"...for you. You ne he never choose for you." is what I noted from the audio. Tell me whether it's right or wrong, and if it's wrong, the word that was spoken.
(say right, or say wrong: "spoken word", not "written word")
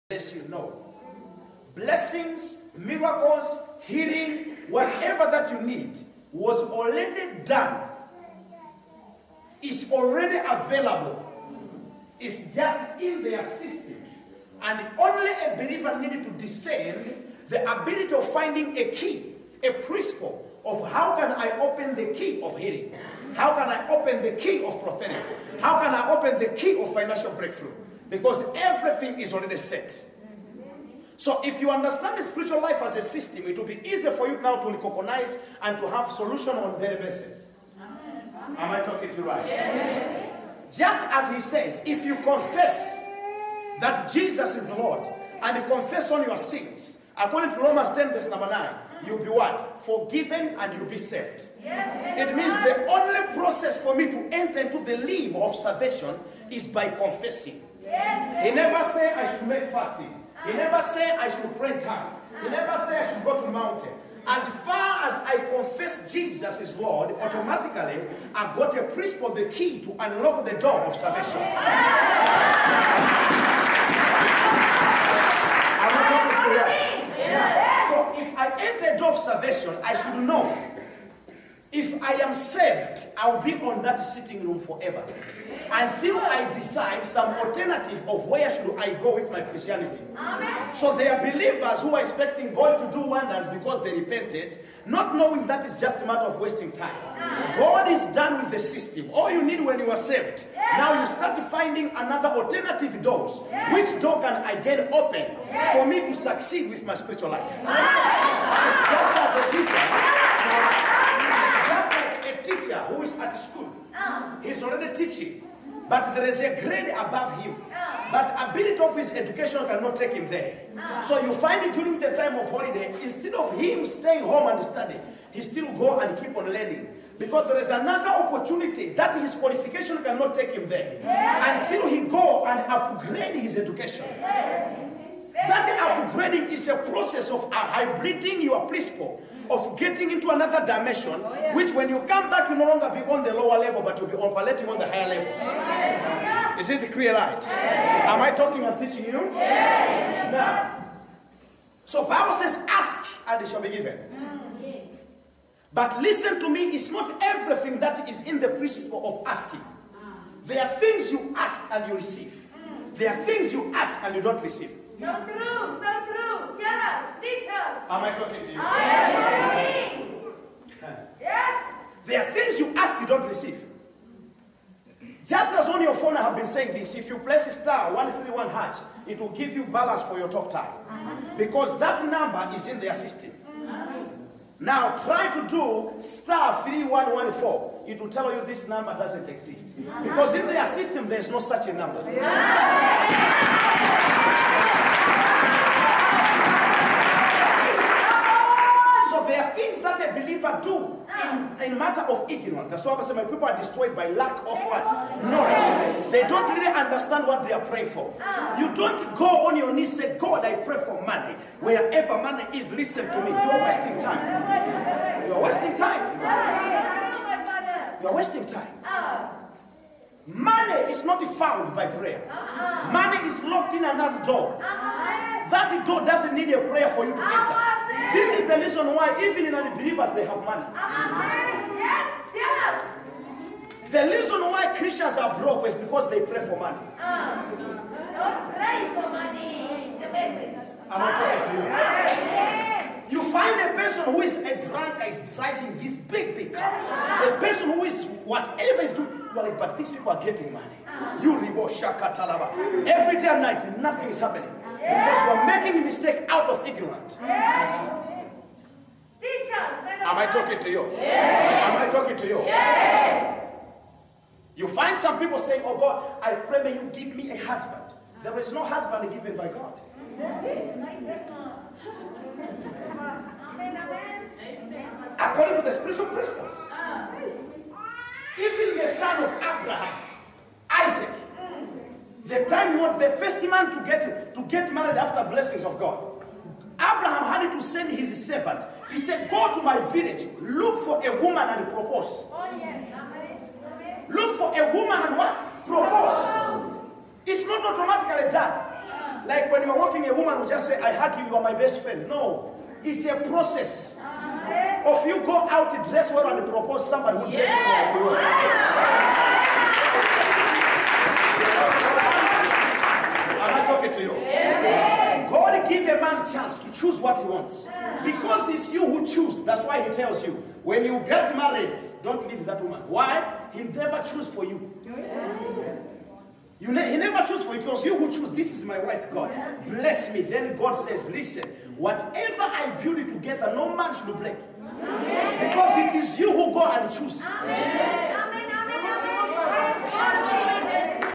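right.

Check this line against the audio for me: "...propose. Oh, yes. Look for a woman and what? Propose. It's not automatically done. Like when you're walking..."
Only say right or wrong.
right.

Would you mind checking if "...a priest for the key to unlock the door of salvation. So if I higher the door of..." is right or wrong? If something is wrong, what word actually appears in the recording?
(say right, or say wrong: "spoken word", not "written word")
wrong: "enter", not "higher".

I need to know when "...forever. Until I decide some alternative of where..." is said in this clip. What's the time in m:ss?
1:24.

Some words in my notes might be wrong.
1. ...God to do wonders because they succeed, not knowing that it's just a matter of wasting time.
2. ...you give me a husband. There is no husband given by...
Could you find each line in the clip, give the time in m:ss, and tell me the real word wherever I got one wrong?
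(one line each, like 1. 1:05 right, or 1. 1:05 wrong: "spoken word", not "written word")
1. 1:32 wrong: "repented", not "succeed"
2. 4:26 right.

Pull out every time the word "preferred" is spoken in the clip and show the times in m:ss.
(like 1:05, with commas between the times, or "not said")
not said.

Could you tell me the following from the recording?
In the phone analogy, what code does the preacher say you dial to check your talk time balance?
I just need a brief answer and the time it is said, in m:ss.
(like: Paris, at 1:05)
*131#, at 2:57.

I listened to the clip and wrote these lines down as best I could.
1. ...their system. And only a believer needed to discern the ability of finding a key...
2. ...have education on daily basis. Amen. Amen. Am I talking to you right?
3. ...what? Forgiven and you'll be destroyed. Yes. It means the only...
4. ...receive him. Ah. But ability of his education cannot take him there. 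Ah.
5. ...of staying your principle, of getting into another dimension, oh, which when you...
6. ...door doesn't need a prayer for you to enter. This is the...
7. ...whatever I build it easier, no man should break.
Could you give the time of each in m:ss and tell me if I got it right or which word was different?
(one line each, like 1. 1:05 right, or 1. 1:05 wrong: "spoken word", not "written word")
1. 0:13 right
2. 0:35 wrong: "solution", not "education"
3. 0:49 wrong: "saved", not "destroyed"
4. 1:56 wrong: "above", not "receive"
5. 2:17 wrong: "hybriding", not "staying"
6. 3:45 right
7. 5:31 wrong: "together", not "easier".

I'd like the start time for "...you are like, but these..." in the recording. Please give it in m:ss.
4:09.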